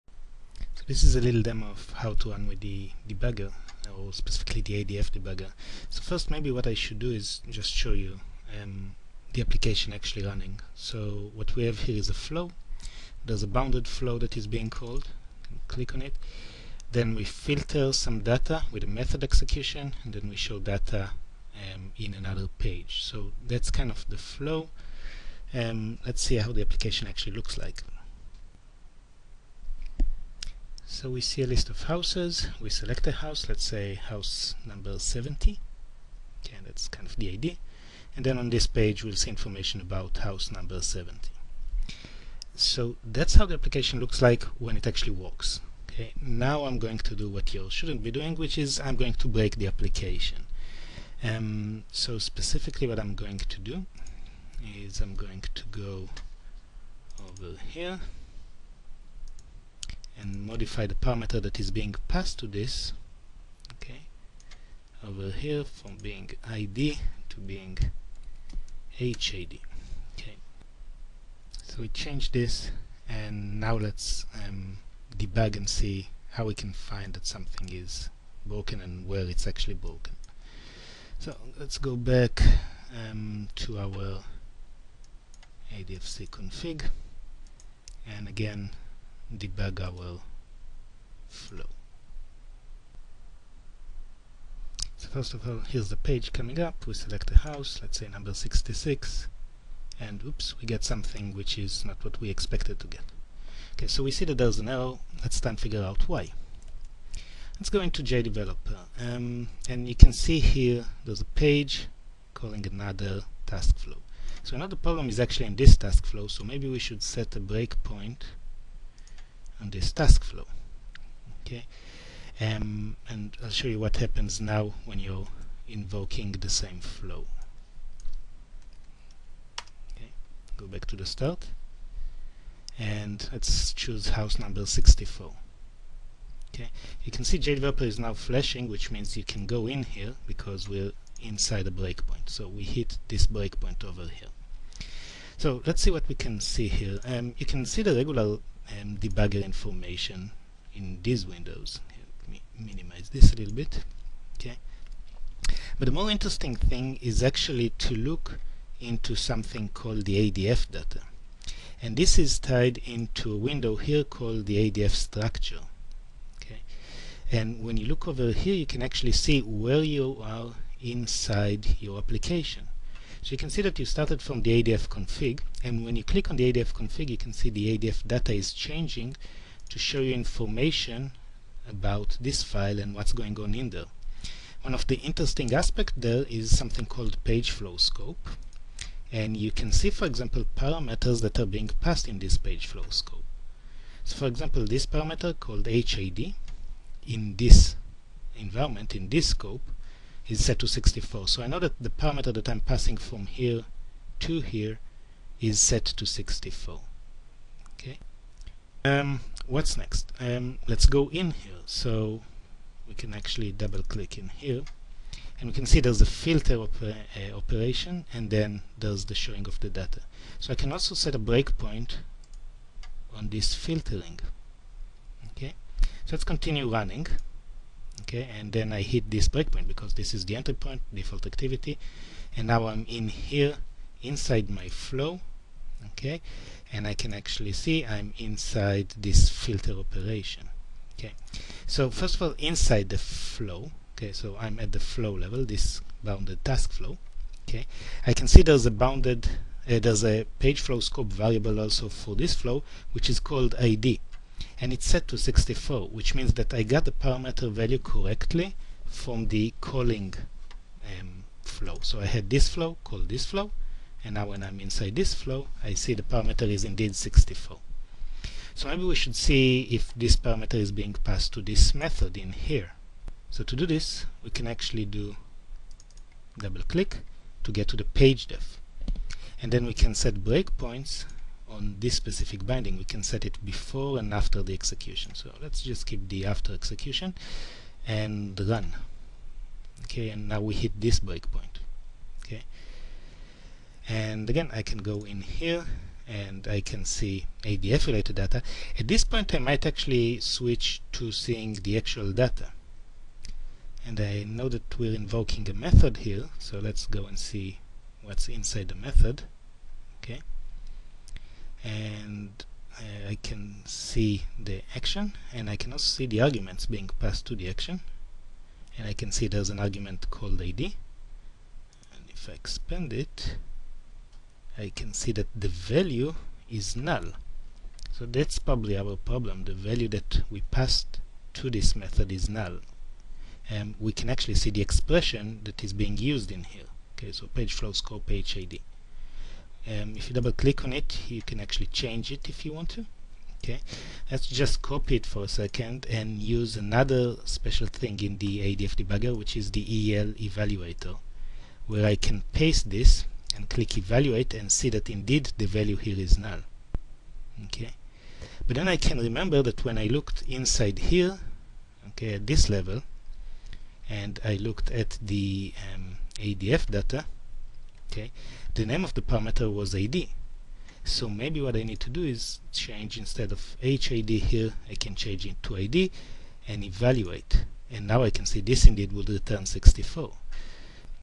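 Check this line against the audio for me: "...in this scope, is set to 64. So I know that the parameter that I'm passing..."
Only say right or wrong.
right.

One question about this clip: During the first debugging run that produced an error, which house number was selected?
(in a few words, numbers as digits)
66.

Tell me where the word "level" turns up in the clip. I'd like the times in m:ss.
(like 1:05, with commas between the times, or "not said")
4:05, 6:02.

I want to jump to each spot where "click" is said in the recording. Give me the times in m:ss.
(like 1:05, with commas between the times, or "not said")
0:15, 2:56, 3:33, 4:36, 5:40, 5:53.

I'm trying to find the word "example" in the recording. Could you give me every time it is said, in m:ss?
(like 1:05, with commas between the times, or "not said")
3:10, 3:14.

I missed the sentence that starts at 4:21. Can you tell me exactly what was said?
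So I had this flow, call this flow and now when I'm inside this flow I see the parameter is indeed 64.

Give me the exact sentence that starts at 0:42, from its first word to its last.
So that's how the application looks like when it actually works.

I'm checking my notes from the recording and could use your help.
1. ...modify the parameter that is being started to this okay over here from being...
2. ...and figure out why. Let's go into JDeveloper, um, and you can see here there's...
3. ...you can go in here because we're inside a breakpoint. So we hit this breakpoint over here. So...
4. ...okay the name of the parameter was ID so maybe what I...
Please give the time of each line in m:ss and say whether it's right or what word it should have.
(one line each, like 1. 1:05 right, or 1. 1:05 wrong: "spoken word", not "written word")
1. 1:00 wrong: "passed", not "started"
2. 1:45 right
3. 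2:19 right
4. 6:07 right.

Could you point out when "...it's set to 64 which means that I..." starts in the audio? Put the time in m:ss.
4:14.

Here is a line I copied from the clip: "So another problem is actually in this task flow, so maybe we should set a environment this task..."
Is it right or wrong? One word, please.
wrong.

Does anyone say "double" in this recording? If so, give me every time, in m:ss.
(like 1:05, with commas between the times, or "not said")
3:33, 4:36, 5:40.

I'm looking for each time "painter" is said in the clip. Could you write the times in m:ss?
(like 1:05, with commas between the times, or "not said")
not said.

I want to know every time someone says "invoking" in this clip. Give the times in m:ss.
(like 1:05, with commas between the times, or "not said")
2:05, 5:04.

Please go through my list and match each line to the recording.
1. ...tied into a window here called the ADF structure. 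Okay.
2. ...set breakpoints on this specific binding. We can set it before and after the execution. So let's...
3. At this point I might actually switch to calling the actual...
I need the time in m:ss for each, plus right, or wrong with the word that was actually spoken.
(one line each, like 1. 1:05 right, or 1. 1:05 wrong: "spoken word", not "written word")
1. 2:42 right
2. 4:39 right
3. 4:58 wrong: "seeing", not "calling".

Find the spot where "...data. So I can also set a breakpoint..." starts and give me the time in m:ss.
3:39.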